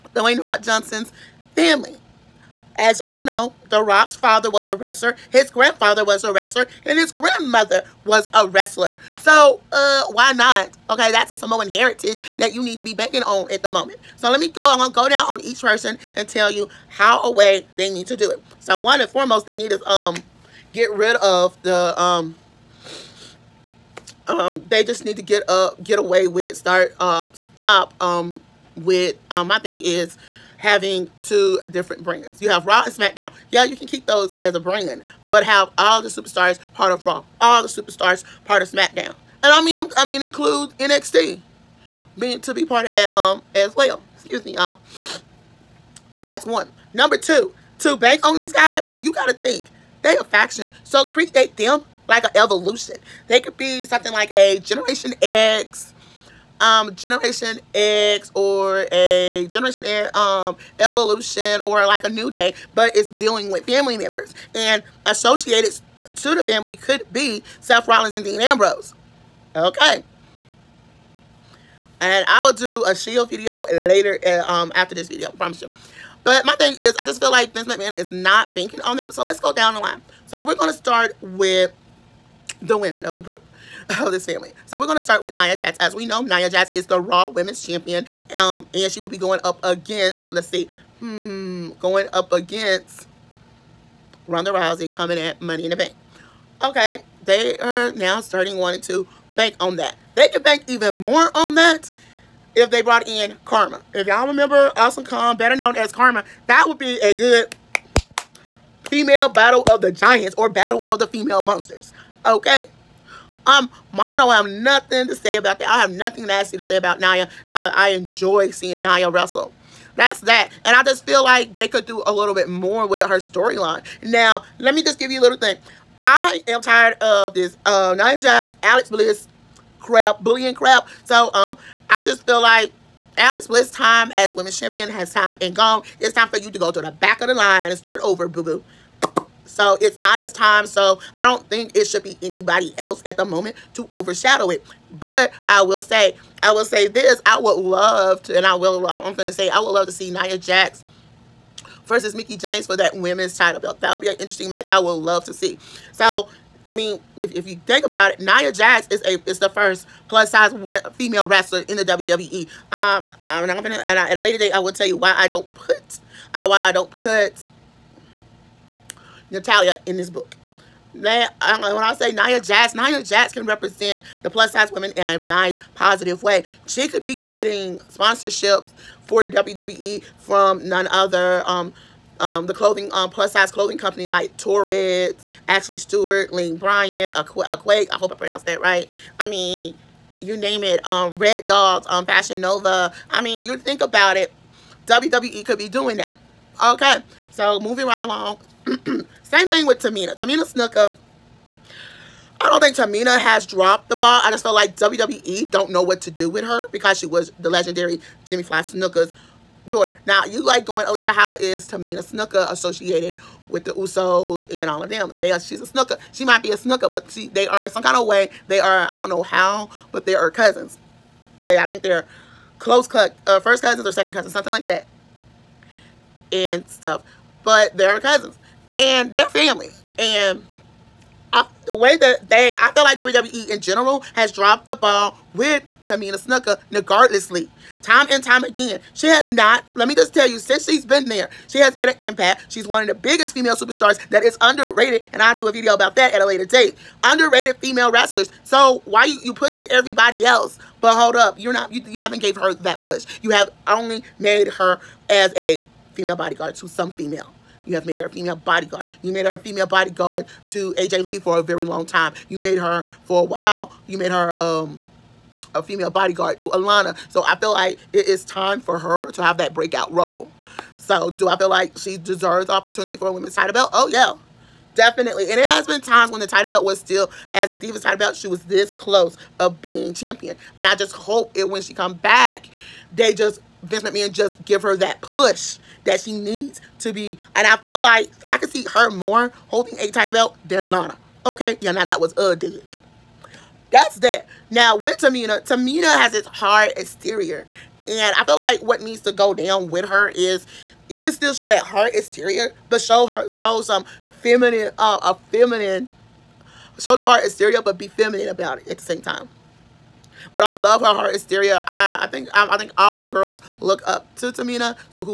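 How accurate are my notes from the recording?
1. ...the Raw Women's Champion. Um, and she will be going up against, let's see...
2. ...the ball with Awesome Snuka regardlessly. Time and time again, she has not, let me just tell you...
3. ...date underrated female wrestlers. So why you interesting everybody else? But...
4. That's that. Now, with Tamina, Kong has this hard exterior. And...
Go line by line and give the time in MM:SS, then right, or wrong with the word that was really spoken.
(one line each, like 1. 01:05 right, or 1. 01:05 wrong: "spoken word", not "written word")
1. 01:26 right
2. 03:54 wrong: "Tamina", not "Awesome"
3. 04:06 wrong: "pushing", not "interesting"
4. 04:53 wrong: "Tamina", not "Kong".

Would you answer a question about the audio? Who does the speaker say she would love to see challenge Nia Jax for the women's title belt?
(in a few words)
Mickie James.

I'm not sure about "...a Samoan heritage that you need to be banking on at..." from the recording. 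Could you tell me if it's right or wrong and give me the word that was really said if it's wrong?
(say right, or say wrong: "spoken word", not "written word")
right.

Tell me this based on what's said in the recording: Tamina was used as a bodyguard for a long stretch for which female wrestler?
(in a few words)
AJ Lee.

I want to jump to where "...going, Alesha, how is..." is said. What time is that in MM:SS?
03:30.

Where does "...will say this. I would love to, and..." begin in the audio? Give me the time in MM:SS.
02:26.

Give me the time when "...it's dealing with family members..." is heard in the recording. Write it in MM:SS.
01:02.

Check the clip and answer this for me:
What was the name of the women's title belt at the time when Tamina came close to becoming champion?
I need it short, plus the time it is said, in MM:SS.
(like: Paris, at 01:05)
Divas title belt, at 04:37.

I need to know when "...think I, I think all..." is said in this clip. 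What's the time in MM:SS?
05:12.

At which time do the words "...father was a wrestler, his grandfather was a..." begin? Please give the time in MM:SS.
00:04.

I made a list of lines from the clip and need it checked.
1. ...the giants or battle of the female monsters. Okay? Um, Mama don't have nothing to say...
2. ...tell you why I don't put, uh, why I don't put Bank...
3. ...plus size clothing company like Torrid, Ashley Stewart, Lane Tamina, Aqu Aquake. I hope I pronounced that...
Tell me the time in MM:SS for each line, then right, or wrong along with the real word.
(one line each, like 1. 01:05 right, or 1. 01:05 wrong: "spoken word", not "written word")
1. 01:49 right
2. 02:44 wrong: "Natalya", not "Bank"
3. 03:03 wrong: "Bryant", not "Tamina".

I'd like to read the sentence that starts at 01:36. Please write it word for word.
Okay, they are now starting wanting to bank on that.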